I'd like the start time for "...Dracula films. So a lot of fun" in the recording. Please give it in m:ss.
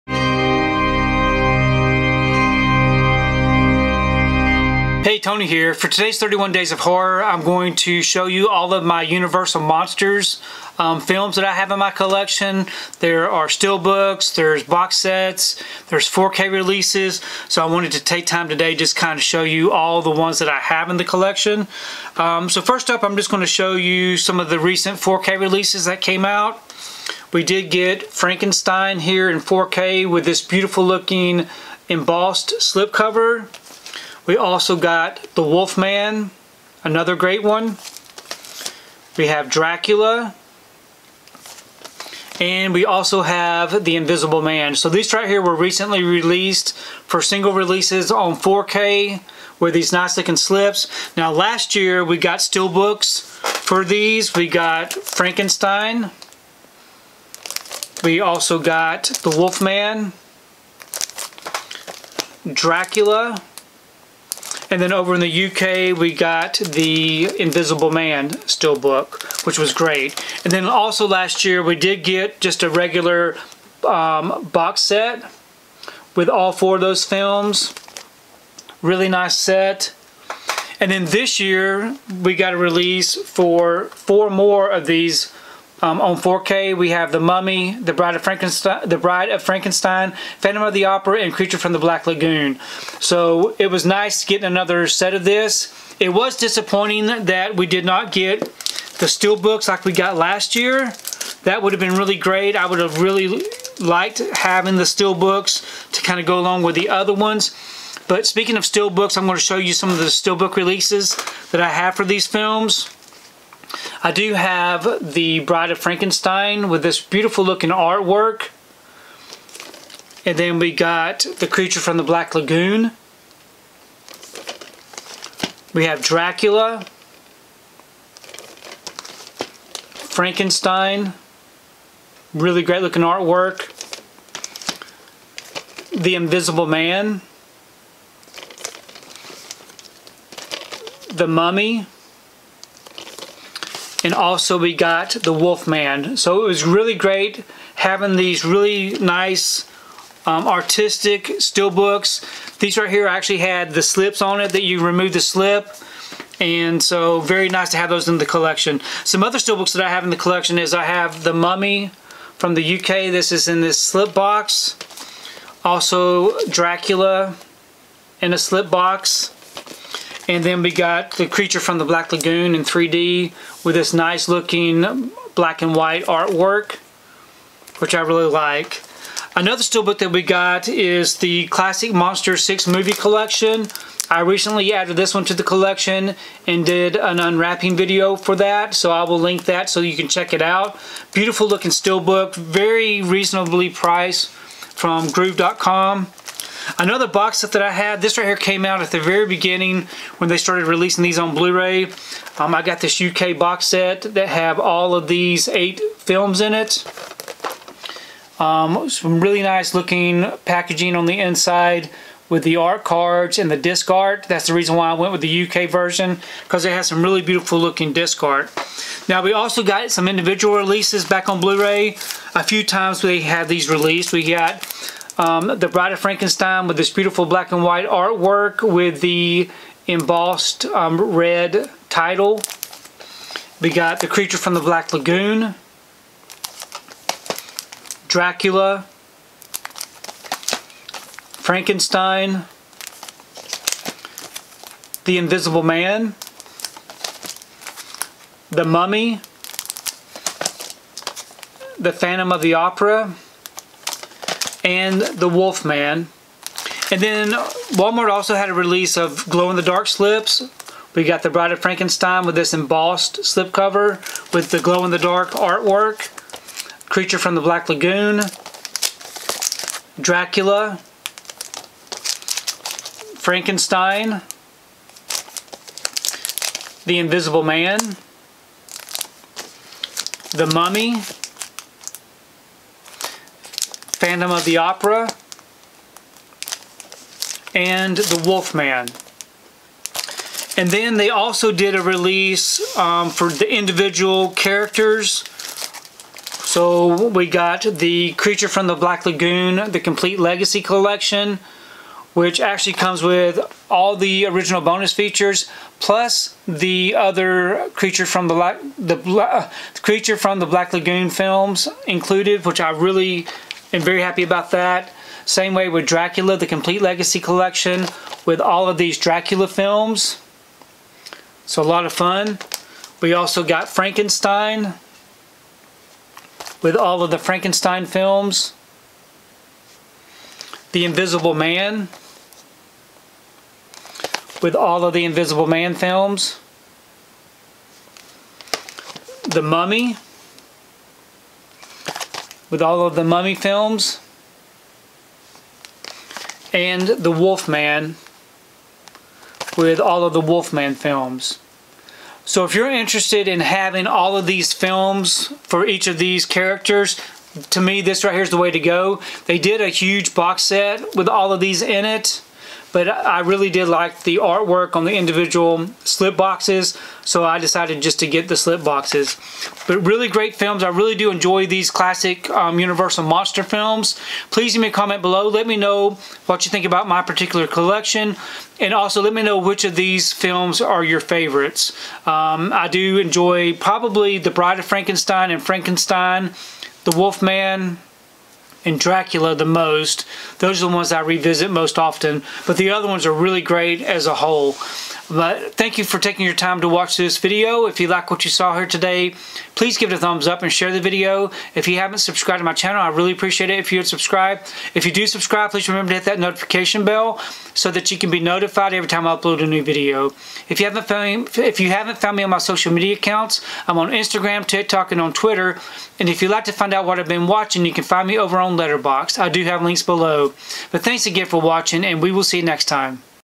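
5:18.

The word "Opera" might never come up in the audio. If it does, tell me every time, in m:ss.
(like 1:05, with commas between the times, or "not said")
1:30, 4:12, 4:44.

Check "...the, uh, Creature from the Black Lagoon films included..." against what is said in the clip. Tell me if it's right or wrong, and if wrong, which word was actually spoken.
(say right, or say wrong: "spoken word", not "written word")
right.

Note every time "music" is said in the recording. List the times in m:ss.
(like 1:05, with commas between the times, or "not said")
not said.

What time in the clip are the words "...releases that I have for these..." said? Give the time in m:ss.
1:50.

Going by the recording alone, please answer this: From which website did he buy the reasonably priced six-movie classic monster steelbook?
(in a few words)
groove.com.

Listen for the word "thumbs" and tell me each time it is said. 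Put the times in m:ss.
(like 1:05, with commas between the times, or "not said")
6:39.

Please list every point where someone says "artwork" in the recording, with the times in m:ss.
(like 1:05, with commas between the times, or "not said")
1:57, 2:13, 2:56, 3:47, 4:25, 6:04.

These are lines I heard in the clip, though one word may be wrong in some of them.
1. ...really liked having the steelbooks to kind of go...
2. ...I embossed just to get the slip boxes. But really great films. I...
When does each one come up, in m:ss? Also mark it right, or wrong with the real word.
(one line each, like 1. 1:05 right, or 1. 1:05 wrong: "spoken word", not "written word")
1. 1:43 right
2. 6:07 wrong: "decided", not "embossed".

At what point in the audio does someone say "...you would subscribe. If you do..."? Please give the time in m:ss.
6:43.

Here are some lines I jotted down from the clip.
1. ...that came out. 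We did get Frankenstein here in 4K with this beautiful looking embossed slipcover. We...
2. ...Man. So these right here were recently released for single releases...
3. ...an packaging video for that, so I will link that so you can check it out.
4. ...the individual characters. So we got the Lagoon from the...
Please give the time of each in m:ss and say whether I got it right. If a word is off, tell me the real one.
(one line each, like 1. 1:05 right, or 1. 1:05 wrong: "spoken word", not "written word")
1. 0:25 right
2. 0:44 right
3. 3:06 wrong: "unwrapping", not "packaging"
4. 4:53 wrong: "Creature", not "Lagoon".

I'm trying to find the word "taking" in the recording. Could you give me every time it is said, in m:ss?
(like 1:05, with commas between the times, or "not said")
6:35.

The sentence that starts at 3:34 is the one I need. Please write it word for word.
That's the reason why I went with the UK version because it has some really beautiful looking disc art.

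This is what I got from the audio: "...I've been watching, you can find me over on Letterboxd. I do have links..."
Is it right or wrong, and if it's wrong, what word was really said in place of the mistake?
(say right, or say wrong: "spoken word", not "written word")
right.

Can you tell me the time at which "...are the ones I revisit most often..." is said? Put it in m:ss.
6:30.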